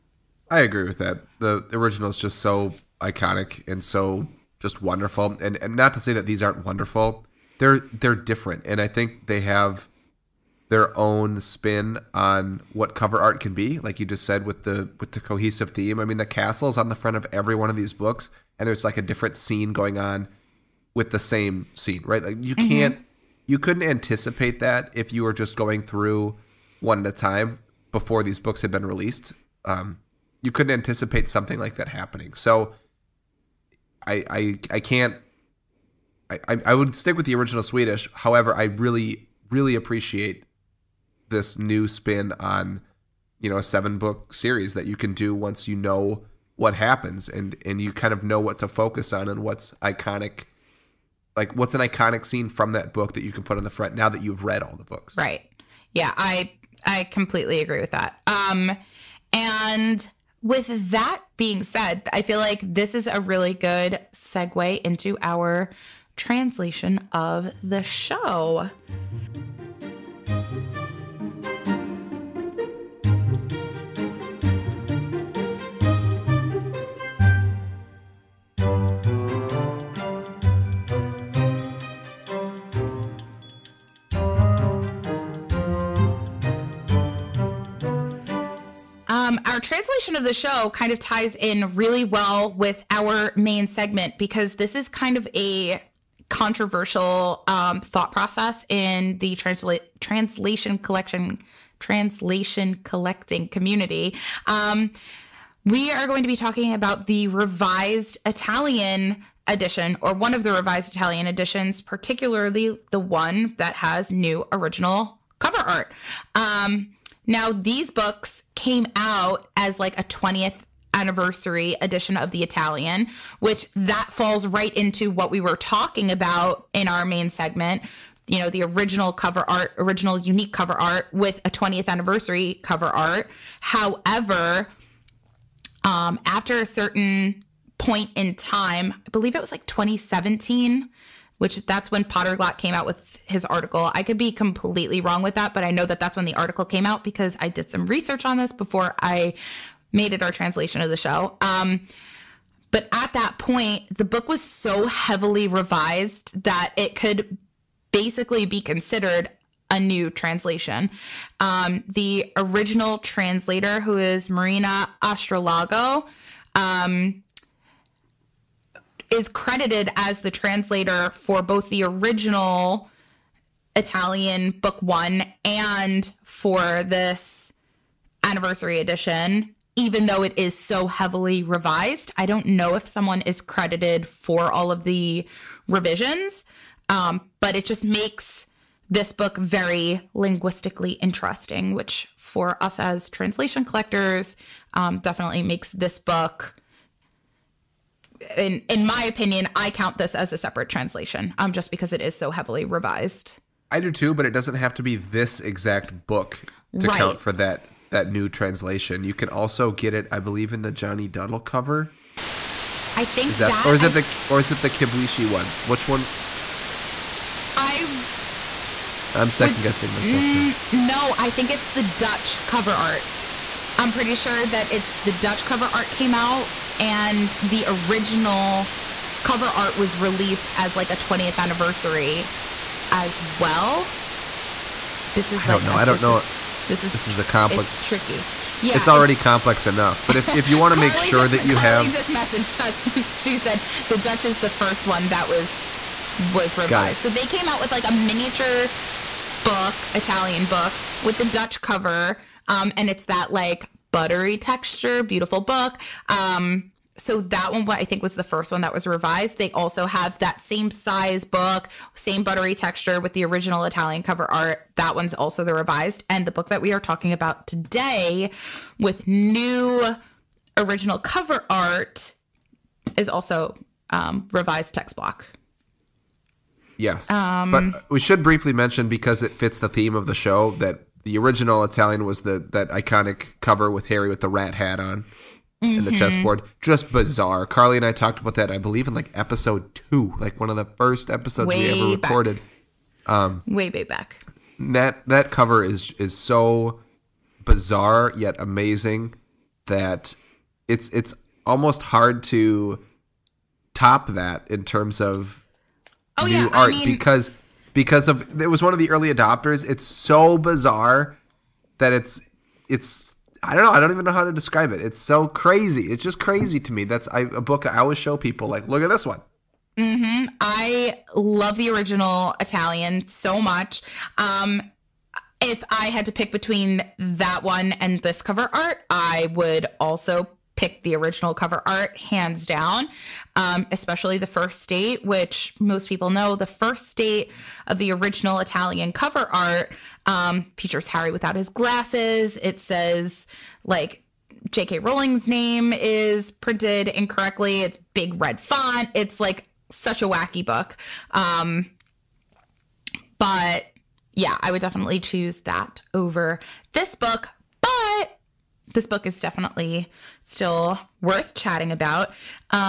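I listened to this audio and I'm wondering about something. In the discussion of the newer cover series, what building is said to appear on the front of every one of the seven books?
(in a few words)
The castle.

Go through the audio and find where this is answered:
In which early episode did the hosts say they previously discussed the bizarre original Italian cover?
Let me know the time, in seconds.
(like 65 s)
289 s.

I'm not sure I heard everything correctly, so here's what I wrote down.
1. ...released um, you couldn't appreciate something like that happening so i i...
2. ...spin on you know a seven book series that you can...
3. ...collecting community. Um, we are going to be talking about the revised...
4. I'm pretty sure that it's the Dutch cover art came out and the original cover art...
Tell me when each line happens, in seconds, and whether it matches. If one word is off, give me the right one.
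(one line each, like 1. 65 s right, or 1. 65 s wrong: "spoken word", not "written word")
1. 28 s wrong: "anticipate", not "appreciate"
2. 41 s right
3. 102 s right
4. 223 s right.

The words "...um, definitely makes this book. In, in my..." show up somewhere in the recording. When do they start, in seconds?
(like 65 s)
194 s.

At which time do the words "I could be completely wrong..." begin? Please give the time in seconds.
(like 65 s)
143 s.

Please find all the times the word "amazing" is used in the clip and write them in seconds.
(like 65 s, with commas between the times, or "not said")
298 s.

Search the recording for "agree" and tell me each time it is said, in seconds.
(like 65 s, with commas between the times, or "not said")
0 s, 57 s.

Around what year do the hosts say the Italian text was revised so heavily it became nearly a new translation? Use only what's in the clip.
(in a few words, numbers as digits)
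2017.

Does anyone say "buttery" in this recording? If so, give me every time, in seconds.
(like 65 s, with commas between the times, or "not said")
253 s, 262 s.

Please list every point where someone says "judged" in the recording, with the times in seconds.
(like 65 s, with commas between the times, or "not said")
not said.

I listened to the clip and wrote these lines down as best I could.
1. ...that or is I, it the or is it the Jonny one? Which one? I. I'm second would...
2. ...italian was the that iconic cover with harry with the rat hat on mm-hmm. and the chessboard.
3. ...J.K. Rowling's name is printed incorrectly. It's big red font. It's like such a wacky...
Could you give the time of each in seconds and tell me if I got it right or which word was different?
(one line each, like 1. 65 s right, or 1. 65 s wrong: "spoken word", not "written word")
1. 213 s wrong: "Kibuishi", not "Jonny"
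2. 281 s right
3. 344 s right.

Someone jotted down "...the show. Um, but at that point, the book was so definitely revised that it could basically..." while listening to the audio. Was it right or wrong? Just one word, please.
wrong.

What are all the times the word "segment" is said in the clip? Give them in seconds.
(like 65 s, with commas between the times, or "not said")
93 s, 127 s.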